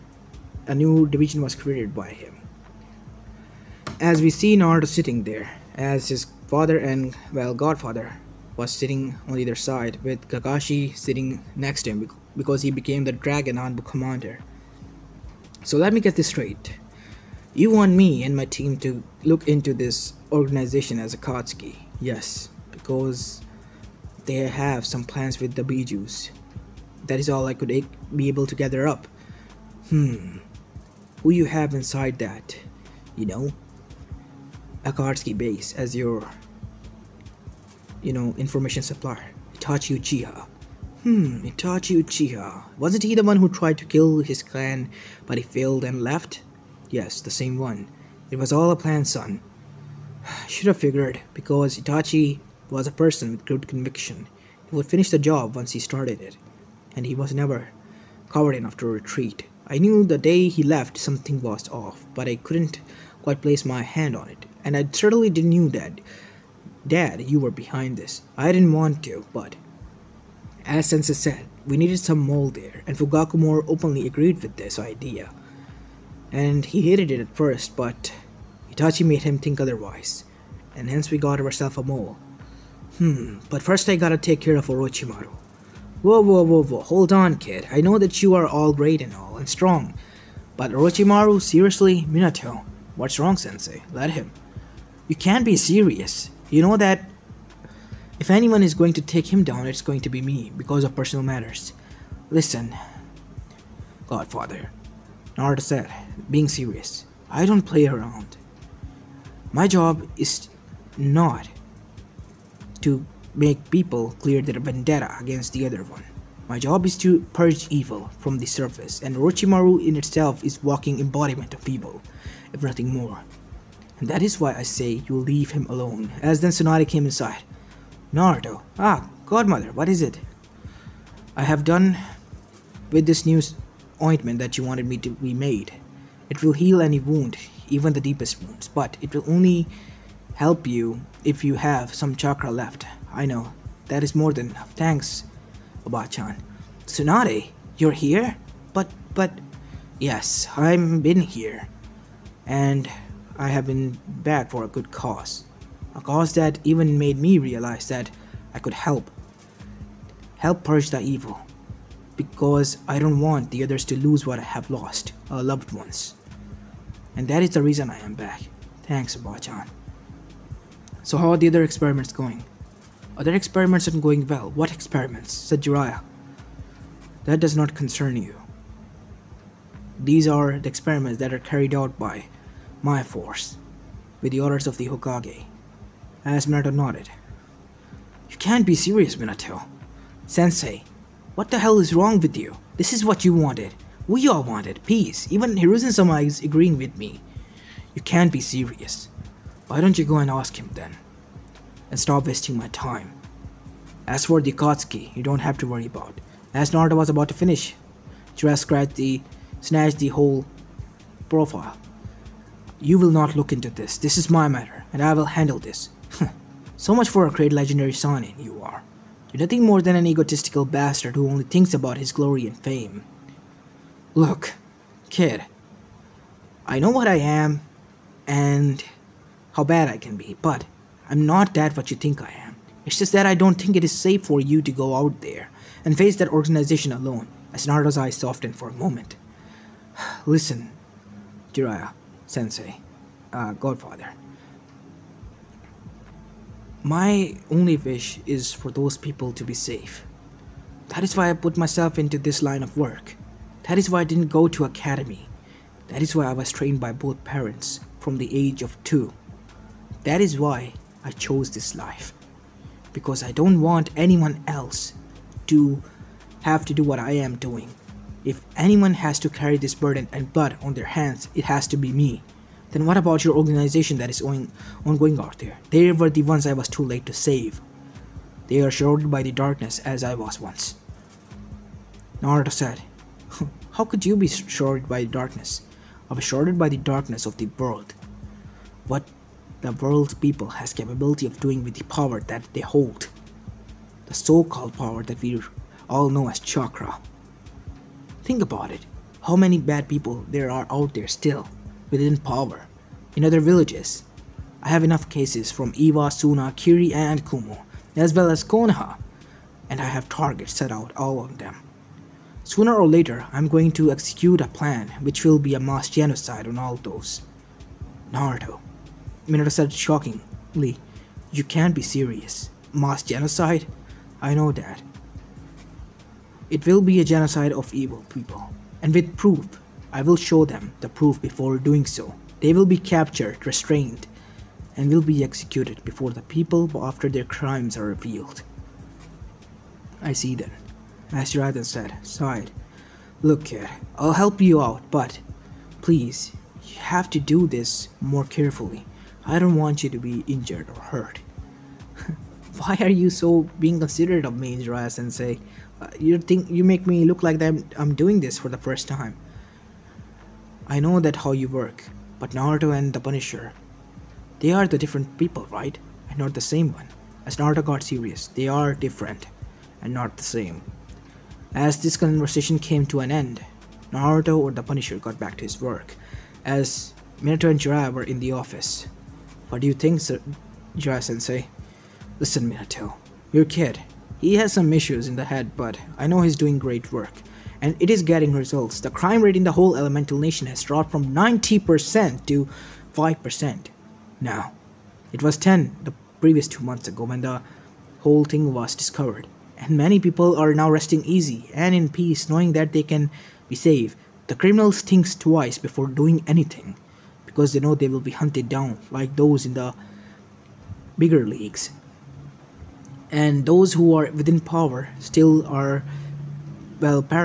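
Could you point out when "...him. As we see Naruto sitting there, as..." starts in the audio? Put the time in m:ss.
0:02.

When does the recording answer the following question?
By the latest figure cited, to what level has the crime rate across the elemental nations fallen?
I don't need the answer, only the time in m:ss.
6:32.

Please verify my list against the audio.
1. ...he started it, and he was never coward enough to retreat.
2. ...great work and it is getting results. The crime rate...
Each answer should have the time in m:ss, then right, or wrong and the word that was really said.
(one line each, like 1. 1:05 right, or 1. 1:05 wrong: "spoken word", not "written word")
1. 0:55 right
2. 6:26 right.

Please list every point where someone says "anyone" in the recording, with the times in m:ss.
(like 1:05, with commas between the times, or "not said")
1:38, 4:23, 4:28.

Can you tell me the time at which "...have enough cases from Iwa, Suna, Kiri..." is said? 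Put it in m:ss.
5:04.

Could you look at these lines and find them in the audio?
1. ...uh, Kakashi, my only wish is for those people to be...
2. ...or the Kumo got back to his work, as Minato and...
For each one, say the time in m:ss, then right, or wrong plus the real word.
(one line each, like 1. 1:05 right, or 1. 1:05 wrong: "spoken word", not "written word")
1. 4:03 wrong: "Godfather", not "Kakashi"
2. 6:14 wrong: "Punisher", not "Kumo".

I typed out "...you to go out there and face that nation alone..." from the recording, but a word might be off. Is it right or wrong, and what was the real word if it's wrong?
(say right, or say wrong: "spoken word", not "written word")
wrong: "organization", not "nation".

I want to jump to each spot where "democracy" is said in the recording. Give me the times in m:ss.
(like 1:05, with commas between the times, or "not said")
not said.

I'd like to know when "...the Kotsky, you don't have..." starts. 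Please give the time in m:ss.
3:24.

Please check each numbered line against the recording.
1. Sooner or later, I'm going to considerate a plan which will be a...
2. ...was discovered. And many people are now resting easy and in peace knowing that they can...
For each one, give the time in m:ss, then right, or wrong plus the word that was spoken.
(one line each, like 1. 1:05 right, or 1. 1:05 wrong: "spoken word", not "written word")
1. 5:12 wrong: "execute", not "considerate"
2. 6:38 right.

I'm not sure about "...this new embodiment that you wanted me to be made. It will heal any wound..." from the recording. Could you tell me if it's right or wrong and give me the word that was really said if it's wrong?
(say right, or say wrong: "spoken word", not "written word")
wrong: "ointment", not "embodiment".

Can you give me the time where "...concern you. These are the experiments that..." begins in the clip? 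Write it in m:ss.
2:57.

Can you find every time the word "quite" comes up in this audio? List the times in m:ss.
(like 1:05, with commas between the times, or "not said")
1:03.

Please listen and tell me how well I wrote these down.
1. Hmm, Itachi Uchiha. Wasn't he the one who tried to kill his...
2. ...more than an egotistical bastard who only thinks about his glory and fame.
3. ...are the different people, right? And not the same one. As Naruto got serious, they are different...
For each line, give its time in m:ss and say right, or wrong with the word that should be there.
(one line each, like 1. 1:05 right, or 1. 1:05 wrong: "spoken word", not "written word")
1. 0:41 right
2. 3:39 right
3. 6:04 right.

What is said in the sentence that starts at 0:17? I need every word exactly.
You want me and my team to look into this organization as Akatsuki?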